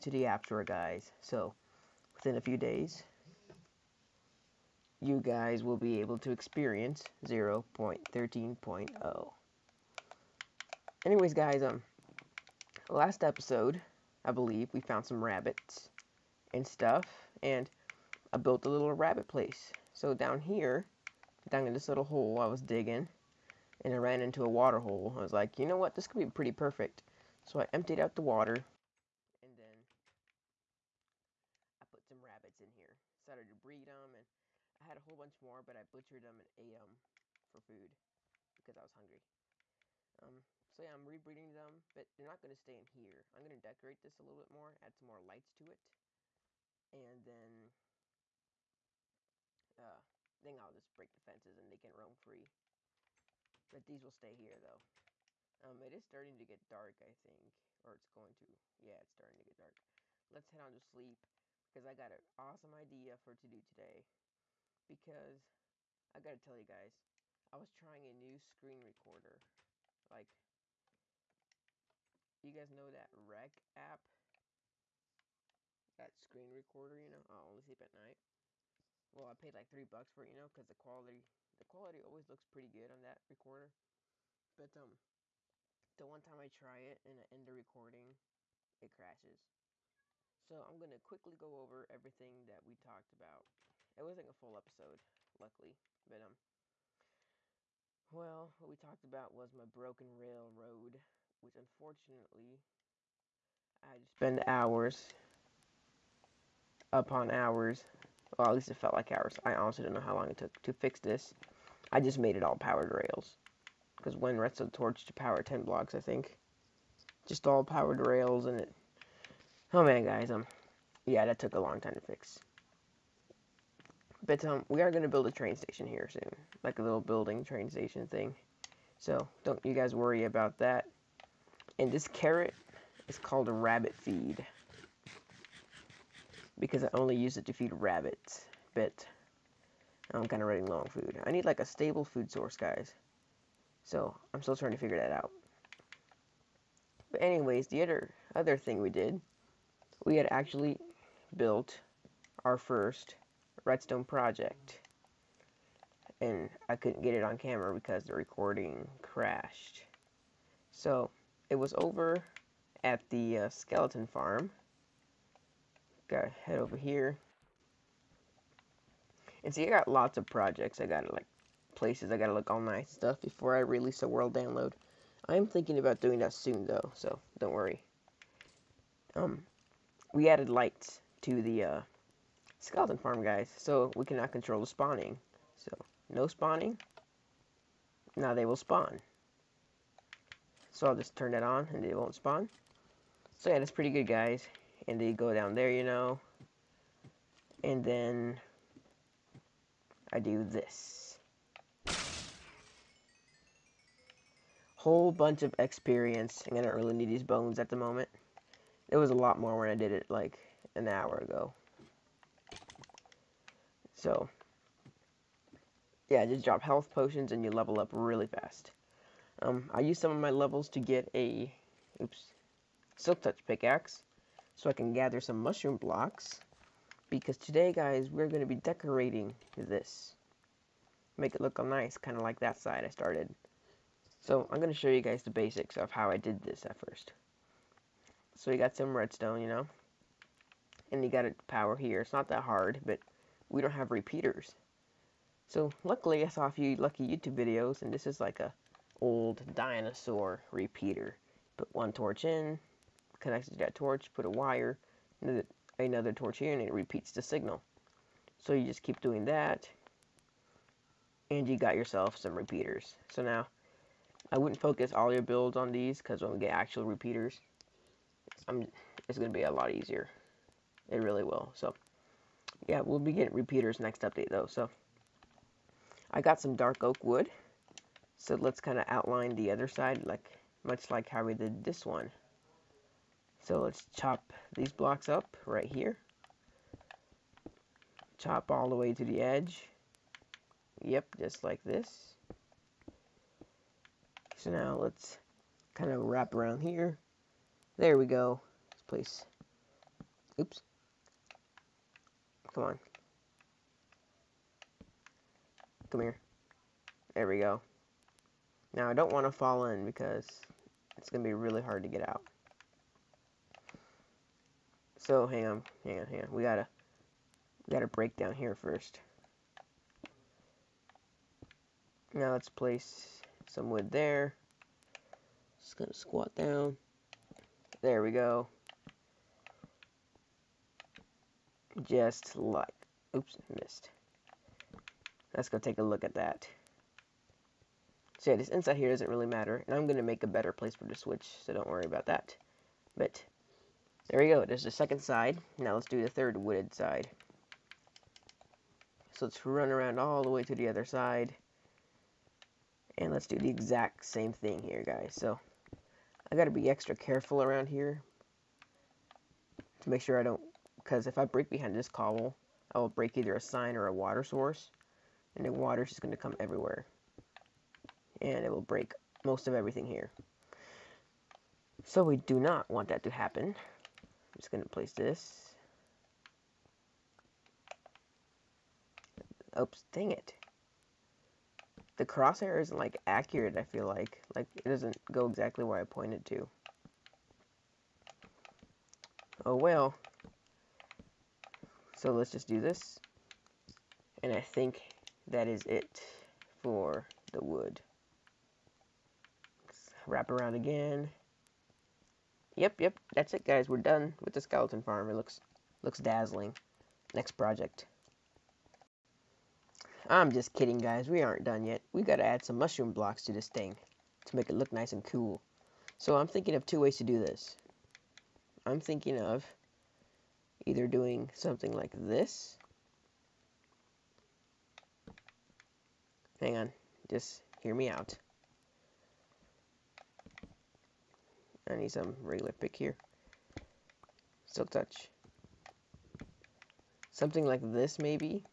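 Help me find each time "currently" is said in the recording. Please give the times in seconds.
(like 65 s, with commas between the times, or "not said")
not said.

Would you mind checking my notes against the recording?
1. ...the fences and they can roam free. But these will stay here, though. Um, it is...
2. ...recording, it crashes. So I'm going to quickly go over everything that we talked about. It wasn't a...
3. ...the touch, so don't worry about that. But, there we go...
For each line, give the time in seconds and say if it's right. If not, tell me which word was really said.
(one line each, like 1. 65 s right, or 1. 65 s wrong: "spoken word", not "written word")
1. 51 s right
2. 87 s right
3. 340 s wrong: "switch", not "touch".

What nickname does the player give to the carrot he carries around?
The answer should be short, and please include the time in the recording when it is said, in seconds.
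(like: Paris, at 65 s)
rabbit feed, at 133 s.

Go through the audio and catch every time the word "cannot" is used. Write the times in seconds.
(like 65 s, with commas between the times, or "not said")
184 s.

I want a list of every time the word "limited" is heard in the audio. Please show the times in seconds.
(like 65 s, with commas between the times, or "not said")
not said.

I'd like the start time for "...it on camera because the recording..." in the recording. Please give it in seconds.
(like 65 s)
157 s.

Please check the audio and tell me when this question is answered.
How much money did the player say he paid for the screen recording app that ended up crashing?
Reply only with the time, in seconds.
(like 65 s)
79 s.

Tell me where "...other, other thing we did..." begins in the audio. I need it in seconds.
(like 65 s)
147 s.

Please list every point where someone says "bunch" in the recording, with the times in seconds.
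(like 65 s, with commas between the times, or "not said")
35 s, 205 s.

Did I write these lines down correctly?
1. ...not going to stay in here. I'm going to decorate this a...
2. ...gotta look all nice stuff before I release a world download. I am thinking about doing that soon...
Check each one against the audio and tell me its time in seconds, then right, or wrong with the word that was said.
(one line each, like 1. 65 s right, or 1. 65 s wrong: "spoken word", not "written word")
1. 42 s right
2. 172 s right.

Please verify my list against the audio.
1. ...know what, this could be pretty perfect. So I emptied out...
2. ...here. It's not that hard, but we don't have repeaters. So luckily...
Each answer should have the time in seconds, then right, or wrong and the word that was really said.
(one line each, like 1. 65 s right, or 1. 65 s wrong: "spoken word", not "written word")
1. 25 s right
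2. 241 s right.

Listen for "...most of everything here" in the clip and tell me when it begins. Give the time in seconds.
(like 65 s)
369 s.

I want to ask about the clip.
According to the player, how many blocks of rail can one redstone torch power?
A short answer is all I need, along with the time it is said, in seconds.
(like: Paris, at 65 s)
10, at 115 s.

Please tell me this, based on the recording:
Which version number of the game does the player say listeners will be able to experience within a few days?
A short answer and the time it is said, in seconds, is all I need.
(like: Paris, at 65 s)
0.13.0, at 7 s.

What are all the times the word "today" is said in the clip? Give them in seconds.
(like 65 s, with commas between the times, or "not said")
63 s, 227 s.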